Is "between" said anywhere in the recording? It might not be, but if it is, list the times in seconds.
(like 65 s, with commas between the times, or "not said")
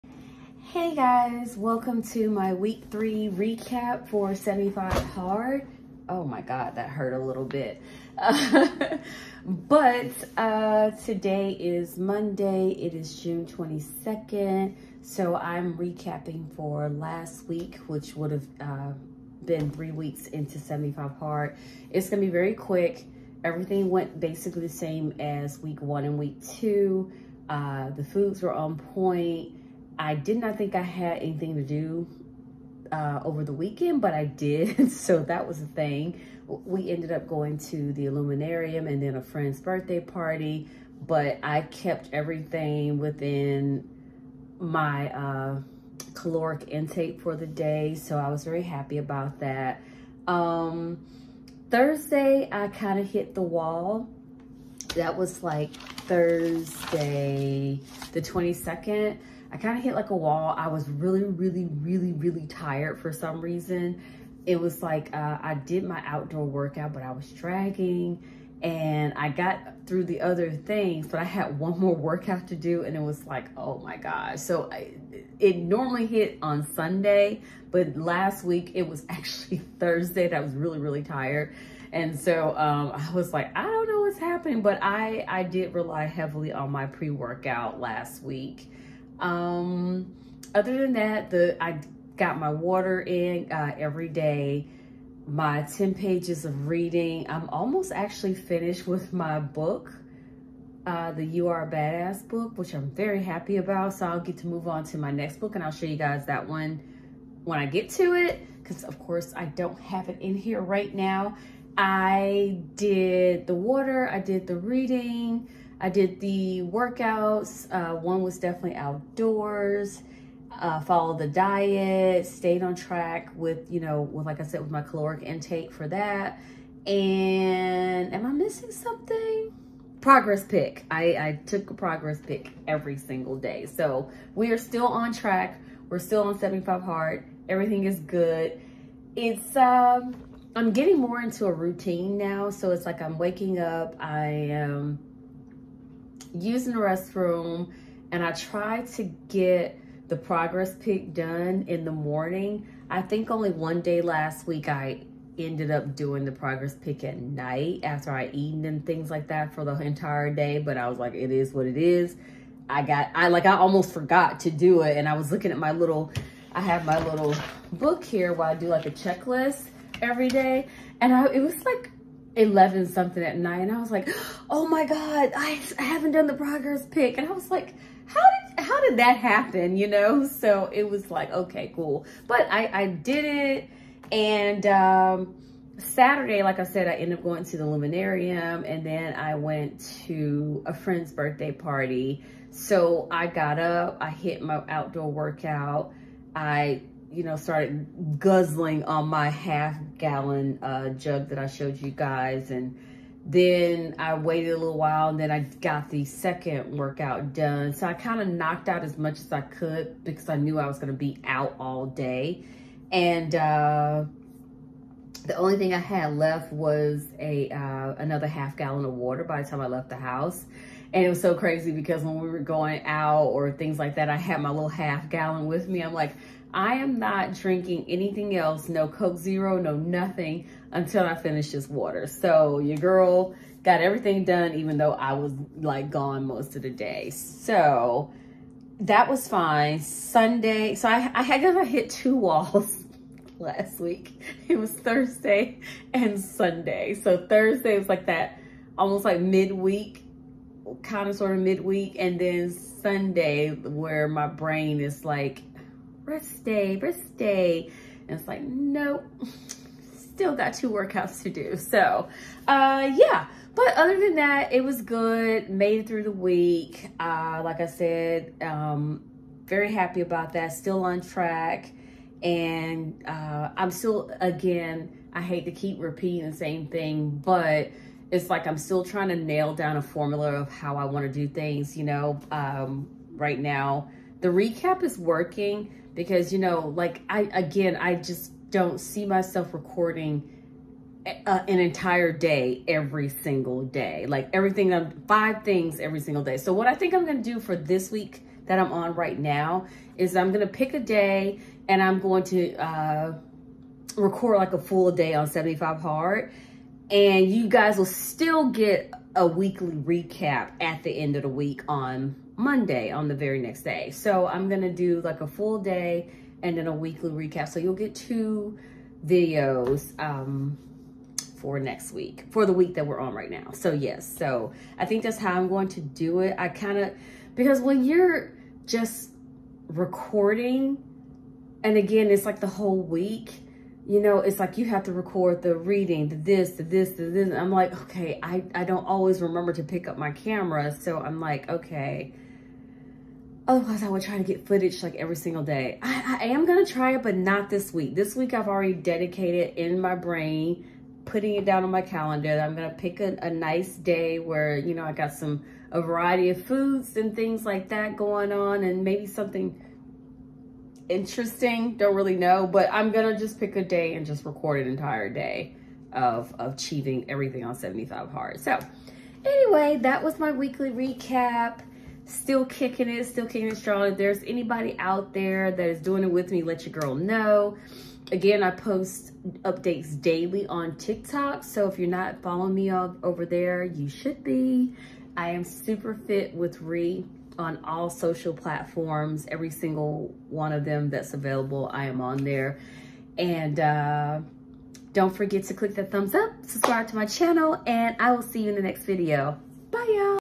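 not said.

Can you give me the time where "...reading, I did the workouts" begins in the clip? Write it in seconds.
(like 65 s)
114 s.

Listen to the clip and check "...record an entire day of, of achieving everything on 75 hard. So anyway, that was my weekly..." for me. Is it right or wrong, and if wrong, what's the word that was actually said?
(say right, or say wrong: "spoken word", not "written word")
right.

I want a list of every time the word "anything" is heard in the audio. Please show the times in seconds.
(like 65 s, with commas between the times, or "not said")
31 s, 227 s.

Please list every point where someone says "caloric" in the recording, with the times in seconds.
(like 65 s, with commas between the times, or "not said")
46 s, 124 s.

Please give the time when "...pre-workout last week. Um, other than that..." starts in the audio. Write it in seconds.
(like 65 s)
86 s.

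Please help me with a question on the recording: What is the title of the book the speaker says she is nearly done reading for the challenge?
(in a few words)
You Are a Badass.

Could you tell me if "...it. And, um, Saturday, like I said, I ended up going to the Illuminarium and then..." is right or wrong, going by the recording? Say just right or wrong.
right.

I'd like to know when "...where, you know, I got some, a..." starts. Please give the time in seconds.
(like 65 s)
354 s.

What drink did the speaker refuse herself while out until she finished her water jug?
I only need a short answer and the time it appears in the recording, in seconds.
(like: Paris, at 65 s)
Coke Zero, at 228 s.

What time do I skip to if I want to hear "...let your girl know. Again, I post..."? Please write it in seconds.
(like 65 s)
376 s.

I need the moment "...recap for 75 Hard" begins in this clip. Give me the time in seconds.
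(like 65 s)
3 s.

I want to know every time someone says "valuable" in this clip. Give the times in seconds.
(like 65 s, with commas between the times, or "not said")
not said.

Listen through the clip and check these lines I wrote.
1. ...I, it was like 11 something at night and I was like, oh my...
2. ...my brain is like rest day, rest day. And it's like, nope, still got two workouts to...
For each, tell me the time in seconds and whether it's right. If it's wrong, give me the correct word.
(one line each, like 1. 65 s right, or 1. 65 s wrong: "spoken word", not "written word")
1. 171 s right
2. 254 s right.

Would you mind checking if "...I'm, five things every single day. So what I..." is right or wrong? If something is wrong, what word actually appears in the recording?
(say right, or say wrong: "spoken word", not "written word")
right.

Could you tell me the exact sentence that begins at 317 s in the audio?
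So you'll get two videos um, for next week, for the week that we're on right now.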